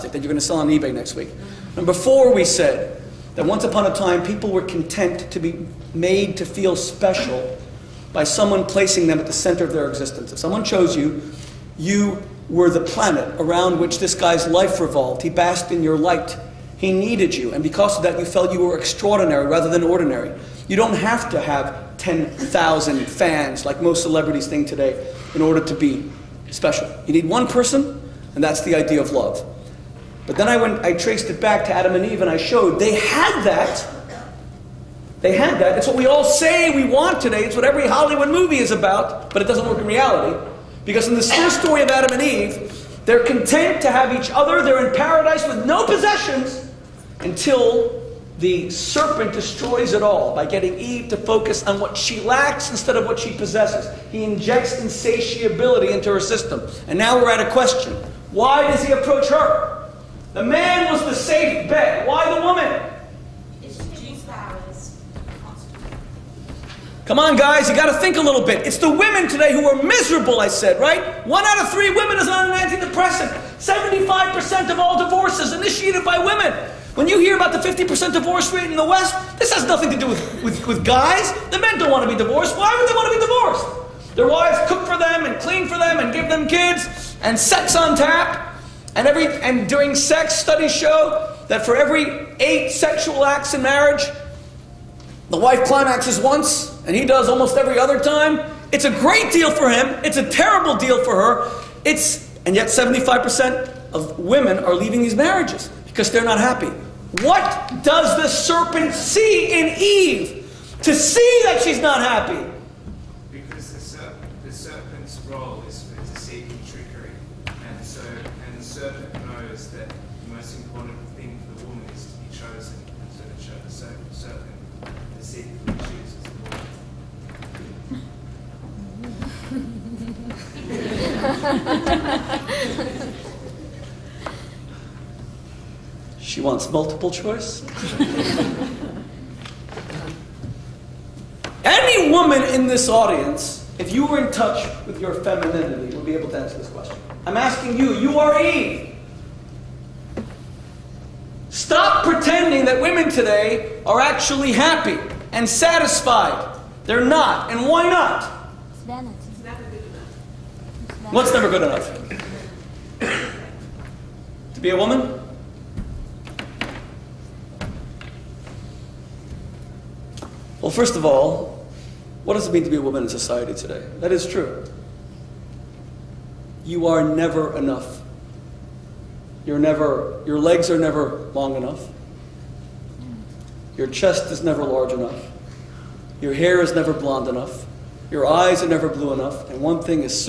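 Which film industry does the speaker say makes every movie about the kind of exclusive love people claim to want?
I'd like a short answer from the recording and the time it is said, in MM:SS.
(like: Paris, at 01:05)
Hollywood, at 00:37.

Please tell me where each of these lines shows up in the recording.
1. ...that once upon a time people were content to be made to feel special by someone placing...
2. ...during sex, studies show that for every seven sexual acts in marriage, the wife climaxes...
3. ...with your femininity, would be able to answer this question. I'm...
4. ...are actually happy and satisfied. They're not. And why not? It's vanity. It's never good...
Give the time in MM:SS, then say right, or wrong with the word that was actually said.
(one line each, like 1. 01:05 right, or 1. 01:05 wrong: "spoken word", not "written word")
1. 00:03 right
2. 01:29 wrong: "eight", not "seven"
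3. 02:24 right
4. 02:33 right.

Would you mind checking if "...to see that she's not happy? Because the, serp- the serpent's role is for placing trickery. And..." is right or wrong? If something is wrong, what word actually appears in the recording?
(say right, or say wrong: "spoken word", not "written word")
wrong: "deceiving", not "placing".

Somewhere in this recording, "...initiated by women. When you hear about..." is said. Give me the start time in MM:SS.
01:15.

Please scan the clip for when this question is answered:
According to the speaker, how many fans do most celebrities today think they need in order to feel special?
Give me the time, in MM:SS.
00:21.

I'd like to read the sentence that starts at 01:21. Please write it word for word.
The men don't want to be divorced.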